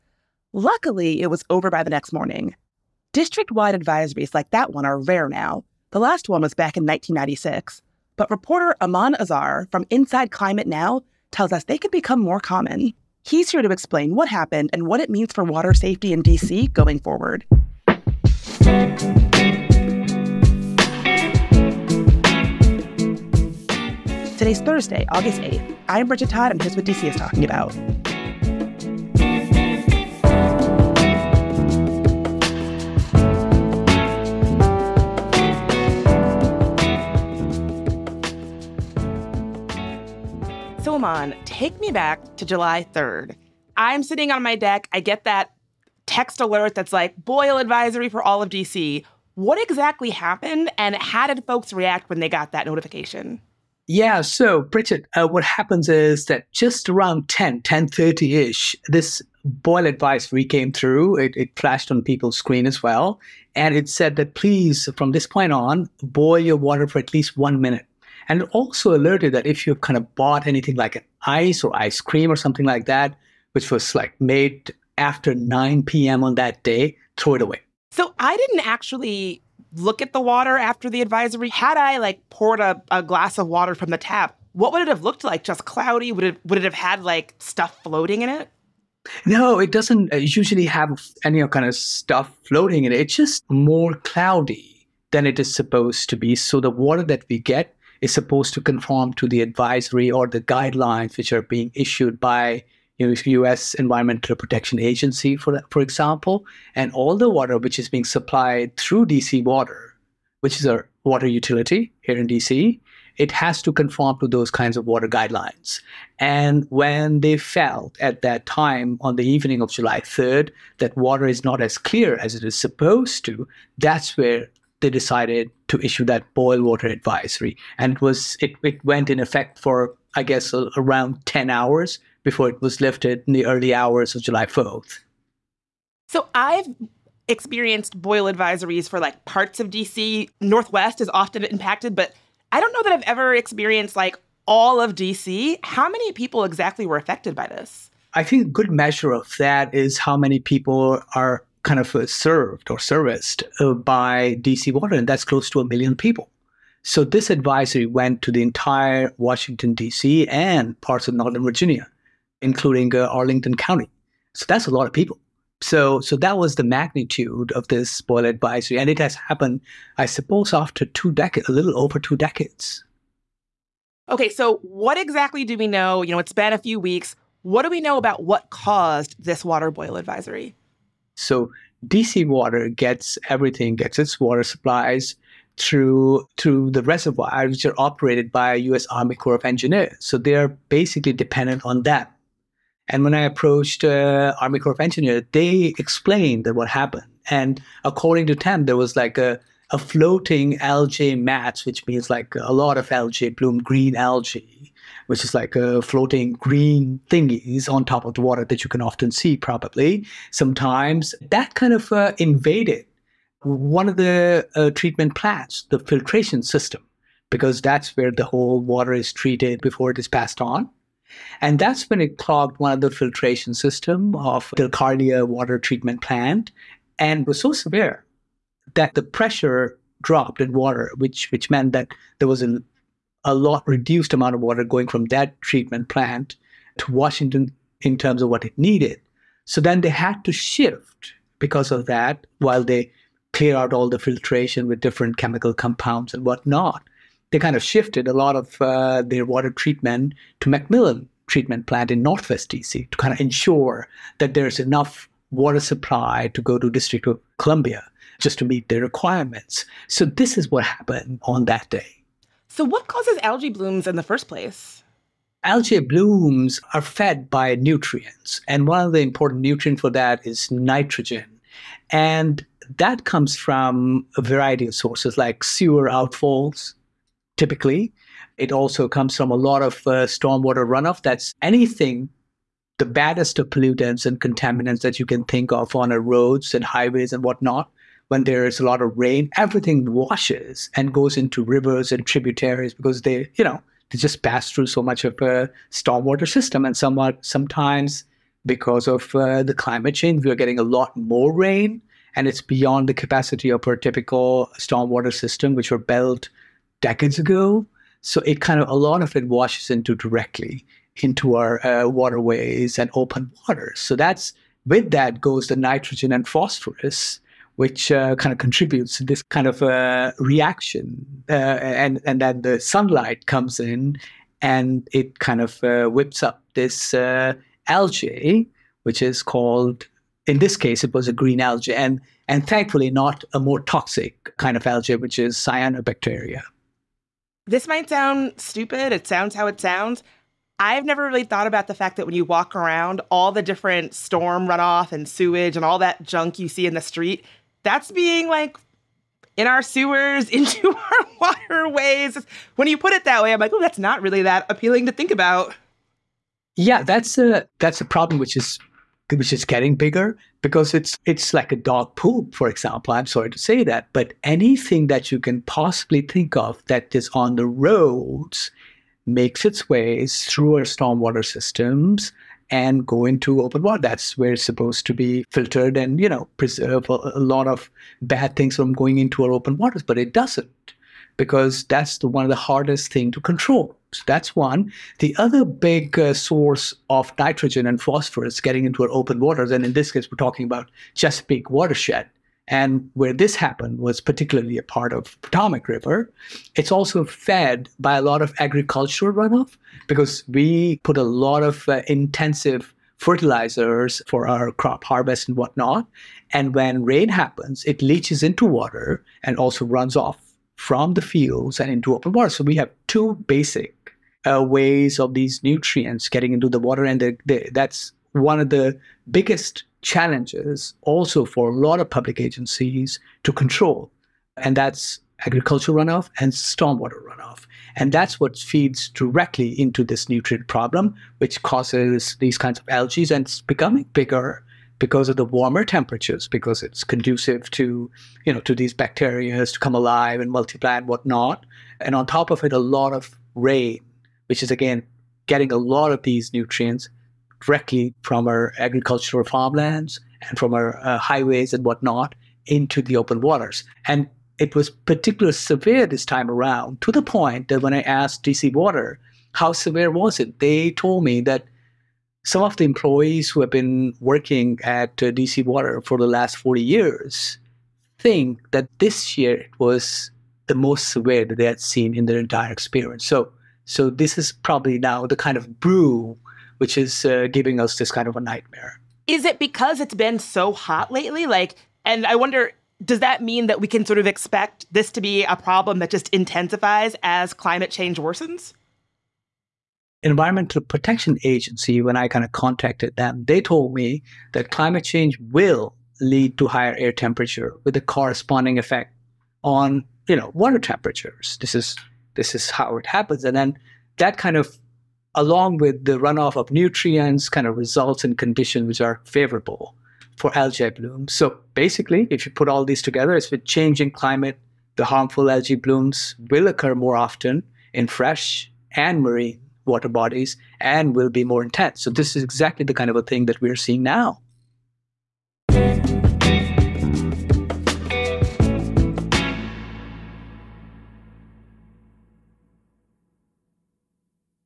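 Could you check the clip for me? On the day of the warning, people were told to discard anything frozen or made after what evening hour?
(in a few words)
9 p.m.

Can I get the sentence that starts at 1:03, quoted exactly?
And it said that please, from this point on, boil your water for at least one minute.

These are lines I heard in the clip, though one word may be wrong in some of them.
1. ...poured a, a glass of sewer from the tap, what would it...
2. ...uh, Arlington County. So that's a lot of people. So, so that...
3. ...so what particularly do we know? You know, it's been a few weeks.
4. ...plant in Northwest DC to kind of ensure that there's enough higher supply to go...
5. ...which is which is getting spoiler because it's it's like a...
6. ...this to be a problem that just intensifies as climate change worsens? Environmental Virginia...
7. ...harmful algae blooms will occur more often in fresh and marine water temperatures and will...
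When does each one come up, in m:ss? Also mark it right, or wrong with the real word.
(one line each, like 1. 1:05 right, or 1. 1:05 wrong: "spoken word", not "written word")
1. 1:22 wrong: "water", not "sewer"
2. 2:42 right
3. 2:54 wrong: "exactly", not "particularly"
4. 4:11 wrong: "water", not "higher"
5. 5:58 wrong: "bigger", not "spoiler"
6. 8:04 wrong: "Protection", not "Virginia"
7. 8:34 wrong: "bodies", not "temperatures".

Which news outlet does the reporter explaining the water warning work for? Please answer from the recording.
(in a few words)
Inside Climate News.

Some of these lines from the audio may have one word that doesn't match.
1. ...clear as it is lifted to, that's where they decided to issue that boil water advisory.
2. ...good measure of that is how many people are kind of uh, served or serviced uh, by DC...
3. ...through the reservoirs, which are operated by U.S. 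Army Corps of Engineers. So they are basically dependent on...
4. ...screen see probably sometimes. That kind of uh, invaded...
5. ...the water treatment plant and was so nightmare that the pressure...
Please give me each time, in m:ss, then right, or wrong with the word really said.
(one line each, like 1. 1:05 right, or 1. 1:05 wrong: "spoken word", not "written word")
1. 2:01 wrong: "supposed", not "lifted"
2. 2:28 right
3. 3:06 right
4. 3:28 wrong: "often", not "screen"
5. 3:44 wrong: "severe", not "nightmare".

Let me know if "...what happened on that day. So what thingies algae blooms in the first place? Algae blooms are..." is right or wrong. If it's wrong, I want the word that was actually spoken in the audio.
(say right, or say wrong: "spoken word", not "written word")
wrong: "causes", not "thingies".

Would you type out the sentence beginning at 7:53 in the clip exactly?
So so this is probably now the kind of brew which is uh, giving us this kind of a nightmare.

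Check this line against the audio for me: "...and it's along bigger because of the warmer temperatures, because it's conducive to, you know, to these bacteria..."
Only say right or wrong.
wrong.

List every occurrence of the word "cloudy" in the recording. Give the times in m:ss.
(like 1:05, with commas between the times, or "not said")
1:25, 1:33.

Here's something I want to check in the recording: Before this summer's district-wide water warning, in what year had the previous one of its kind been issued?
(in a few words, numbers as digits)
1996.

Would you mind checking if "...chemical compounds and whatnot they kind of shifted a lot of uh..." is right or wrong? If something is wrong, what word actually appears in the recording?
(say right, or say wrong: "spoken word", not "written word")
right.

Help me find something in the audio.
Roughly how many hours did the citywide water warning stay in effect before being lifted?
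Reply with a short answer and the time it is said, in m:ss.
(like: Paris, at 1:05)
10, at 2:11.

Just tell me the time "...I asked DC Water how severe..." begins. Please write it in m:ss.
7:37.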